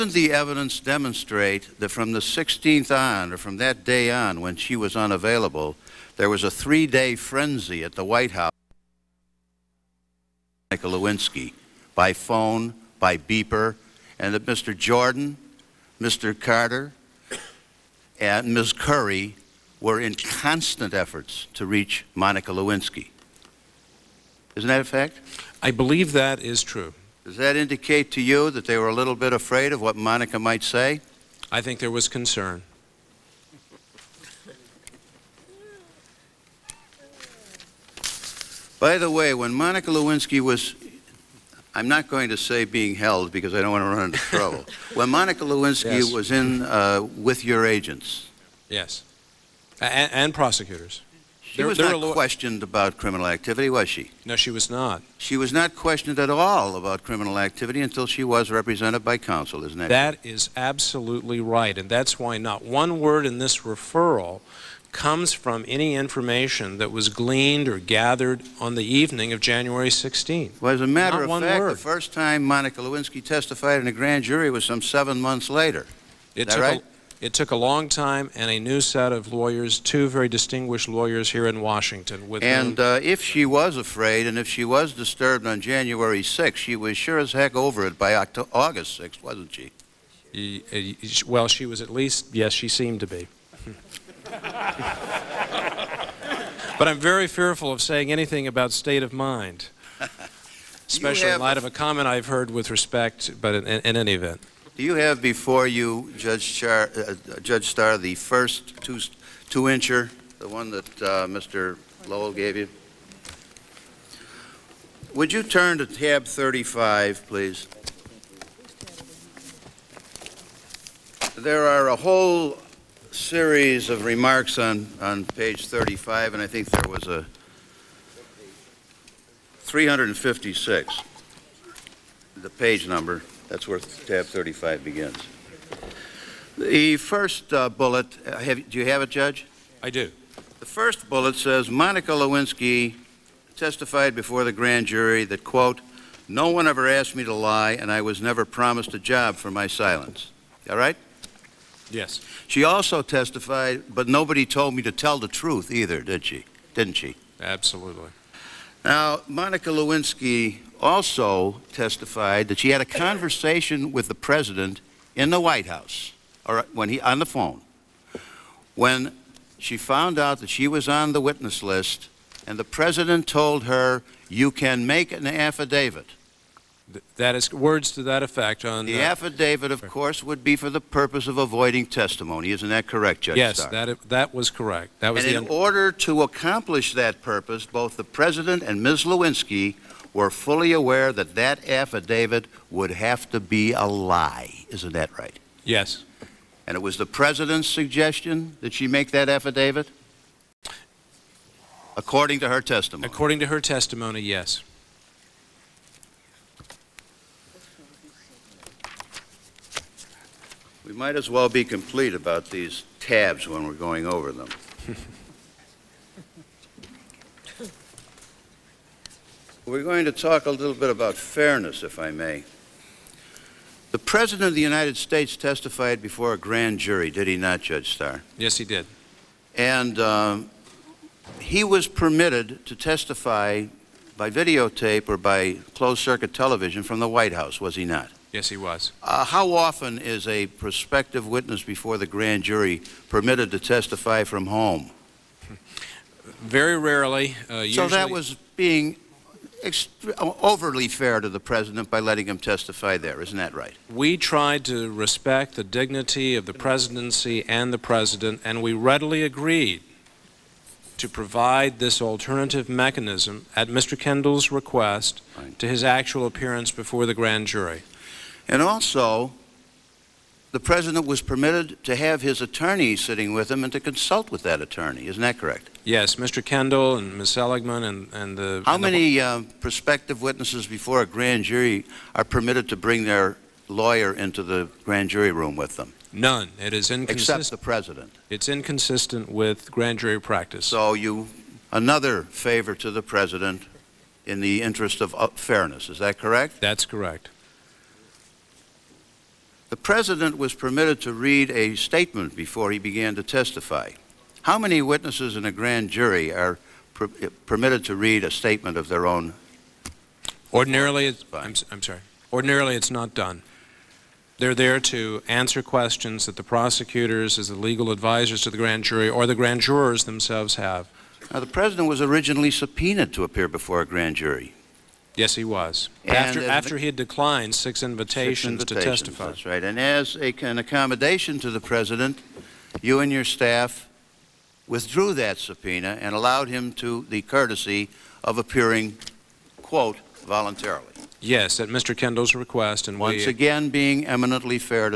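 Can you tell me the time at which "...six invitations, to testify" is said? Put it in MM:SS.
05:28.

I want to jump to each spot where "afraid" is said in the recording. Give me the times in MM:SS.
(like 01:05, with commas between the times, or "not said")
00:29, 01:23.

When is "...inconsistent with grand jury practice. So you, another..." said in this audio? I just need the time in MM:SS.
04:48.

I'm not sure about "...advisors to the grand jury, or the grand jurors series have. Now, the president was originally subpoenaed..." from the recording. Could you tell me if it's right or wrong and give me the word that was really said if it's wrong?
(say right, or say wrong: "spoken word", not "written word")
wrong: "themselves", not "series".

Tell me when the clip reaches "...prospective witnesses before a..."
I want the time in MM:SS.
04:39.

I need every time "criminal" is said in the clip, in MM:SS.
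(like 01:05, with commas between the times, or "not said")
00:52, 00:57.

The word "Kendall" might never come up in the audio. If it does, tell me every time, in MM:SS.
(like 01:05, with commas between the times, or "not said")
04:23, 04:36, 05:41.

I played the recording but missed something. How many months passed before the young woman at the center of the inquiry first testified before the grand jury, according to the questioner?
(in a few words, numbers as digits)
7.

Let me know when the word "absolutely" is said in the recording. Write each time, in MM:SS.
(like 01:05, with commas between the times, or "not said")
01:00, 02:37.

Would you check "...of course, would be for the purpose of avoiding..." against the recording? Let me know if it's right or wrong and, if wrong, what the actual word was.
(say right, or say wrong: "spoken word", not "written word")
right.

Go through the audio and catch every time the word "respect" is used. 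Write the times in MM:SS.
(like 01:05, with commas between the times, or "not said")
01:42, 04:14.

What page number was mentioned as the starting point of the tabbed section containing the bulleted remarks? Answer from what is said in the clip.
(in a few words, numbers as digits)
356.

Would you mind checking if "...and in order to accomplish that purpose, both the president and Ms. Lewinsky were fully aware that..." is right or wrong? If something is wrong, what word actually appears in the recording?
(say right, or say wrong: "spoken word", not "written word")
right.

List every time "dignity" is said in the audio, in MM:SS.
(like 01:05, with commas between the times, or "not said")
04:15.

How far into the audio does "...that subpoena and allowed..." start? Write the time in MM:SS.
05:35.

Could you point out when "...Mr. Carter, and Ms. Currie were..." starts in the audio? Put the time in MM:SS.
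00:16.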